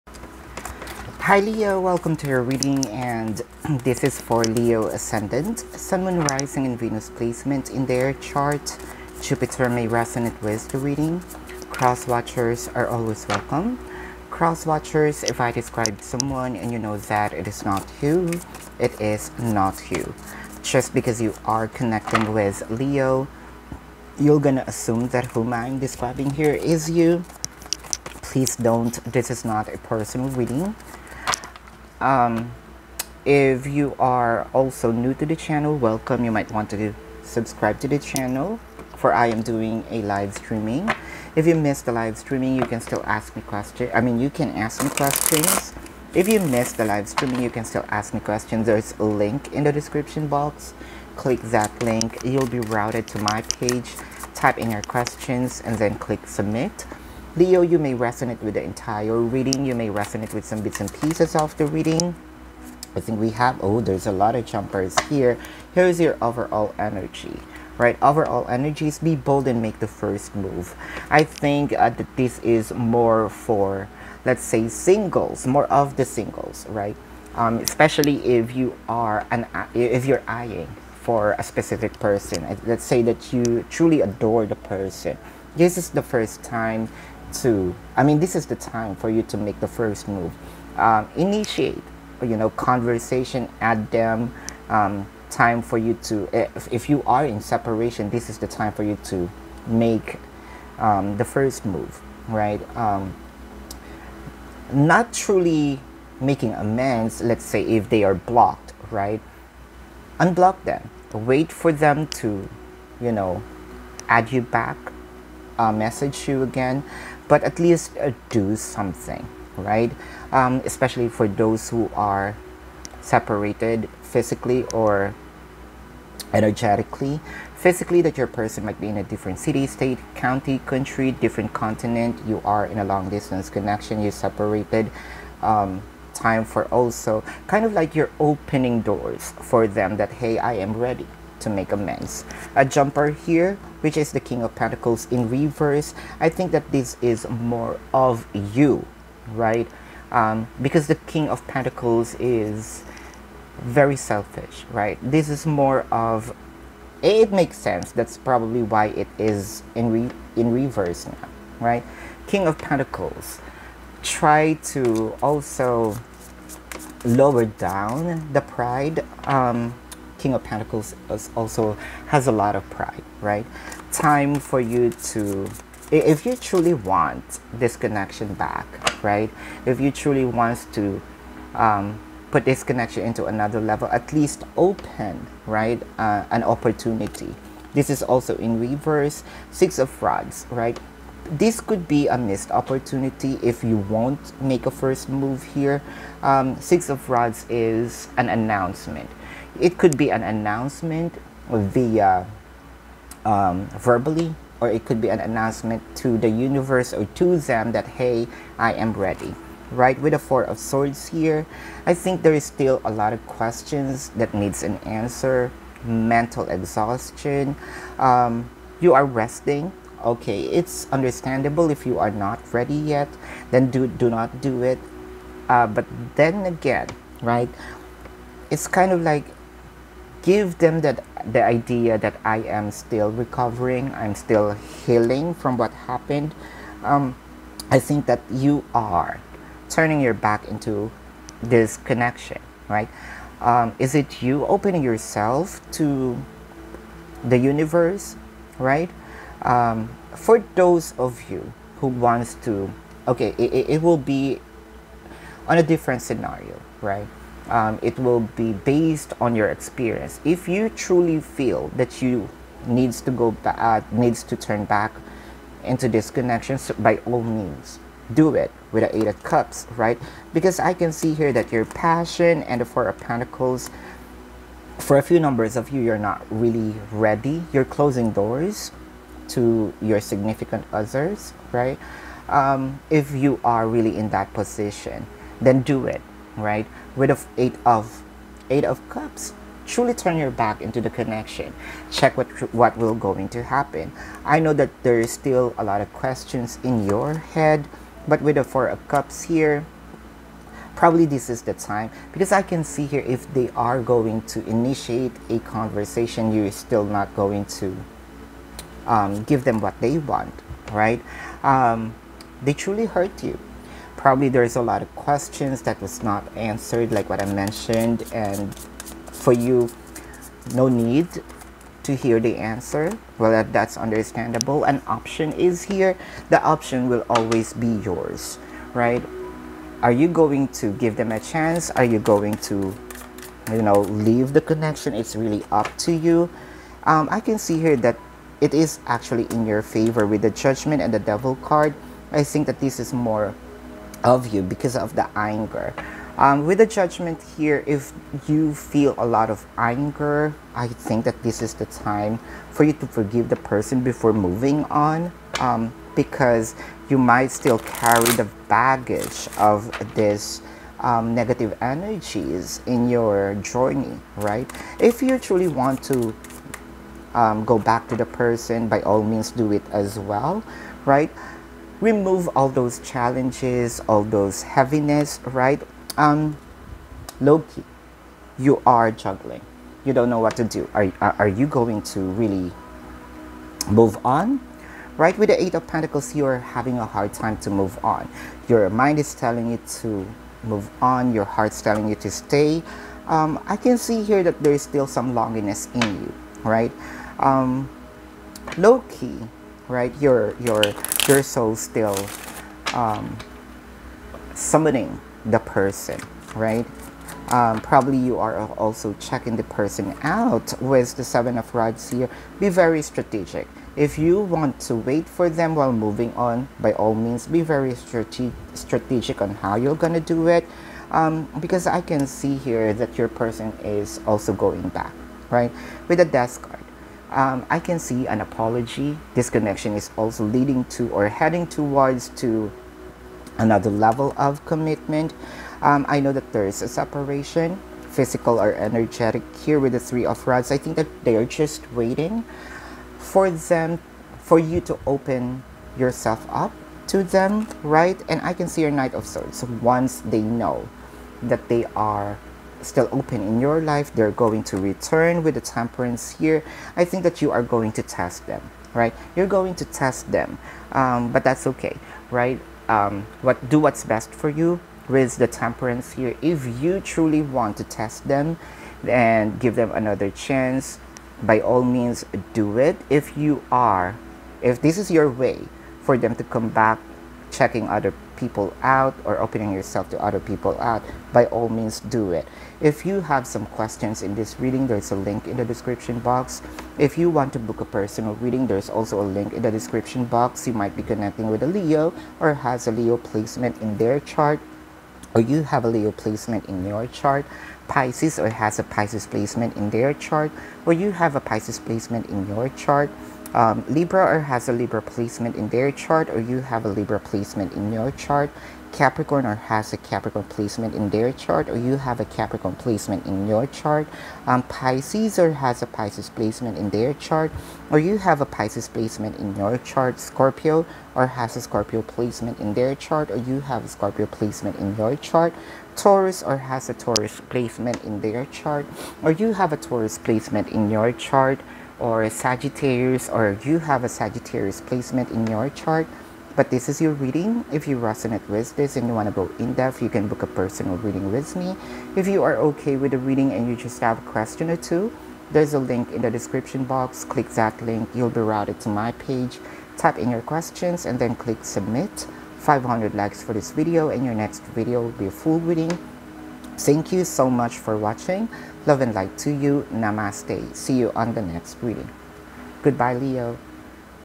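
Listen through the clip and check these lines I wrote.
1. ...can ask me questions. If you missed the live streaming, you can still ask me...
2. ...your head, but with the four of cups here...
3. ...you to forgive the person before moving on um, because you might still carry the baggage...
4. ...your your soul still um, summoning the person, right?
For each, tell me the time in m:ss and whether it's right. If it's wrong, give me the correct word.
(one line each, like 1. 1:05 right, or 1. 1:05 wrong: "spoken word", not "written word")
1. 0:44 right
2. 4:56 right
3. 5:52 right
4. 6:40 right.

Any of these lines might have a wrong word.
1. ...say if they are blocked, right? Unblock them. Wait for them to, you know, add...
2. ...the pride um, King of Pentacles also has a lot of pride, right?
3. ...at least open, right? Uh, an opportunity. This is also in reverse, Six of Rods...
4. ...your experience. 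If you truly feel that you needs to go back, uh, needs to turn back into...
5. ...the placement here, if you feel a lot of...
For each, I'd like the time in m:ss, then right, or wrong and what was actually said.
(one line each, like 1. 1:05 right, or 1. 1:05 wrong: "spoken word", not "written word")
1. 1:47 right
2. 2:48 right
3. 3:03 right
4. 4:19 right
5. 5:46 wrong: "judgment", not "placement".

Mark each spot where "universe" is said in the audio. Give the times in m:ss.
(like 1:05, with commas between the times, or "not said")
3:26, 4:07.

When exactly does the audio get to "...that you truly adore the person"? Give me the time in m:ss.
1:23.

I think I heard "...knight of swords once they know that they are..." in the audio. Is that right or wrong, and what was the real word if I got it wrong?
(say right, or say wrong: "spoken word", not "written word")
right.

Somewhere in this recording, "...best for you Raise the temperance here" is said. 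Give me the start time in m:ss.
7:43.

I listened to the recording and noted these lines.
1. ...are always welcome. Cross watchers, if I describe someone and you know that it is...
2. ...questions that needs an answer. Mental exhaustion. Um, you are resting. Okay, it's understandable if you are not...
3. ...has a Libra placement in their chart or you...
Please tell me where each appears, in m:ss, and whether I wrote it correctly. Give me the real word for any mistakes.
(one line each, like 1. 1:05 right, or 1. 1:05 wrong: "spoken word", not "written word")
1. 0:12 right
2. 3:33 right
3. 8:24 right.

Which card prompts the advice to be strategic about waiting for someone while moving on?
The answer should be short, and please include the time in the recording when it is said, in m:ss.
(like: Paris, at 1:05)
Seven of Rods, at 6:51.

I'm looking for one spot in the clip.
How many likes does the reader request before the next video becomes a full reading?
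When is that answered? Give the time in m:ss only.
9:12.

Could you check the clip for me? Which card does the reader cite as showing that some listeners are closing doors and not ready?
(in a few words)
Four of Pentacles.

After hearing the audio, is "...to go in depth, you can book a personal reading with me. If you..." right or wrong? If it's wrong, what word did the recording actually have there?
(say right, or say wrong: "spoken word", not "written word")
right.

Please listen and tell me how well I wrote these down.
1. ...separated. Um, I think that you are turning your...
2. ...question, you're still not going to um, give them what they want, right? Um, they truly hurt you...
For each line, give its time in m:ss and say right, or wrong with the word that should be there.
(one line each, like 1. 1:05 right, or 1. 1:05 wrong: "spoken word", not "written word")
1. 3:55 wrong: "happened", not "separated"
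2. 5:05 wrong: "conversation", not "question".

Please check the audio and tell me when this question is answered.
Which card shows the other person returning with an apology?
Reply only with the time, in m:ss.
7:06.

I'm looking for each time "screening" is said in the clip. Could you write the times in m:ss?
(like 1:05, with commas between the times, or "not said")
not said.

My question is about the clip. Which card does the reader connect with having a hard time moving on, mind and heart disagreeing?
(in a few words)
Eight of Pentacles.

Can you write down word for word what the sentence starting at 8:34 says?
Um, Pisces or has a Pisces placement in their chart or you have a Pisces placement in your chart.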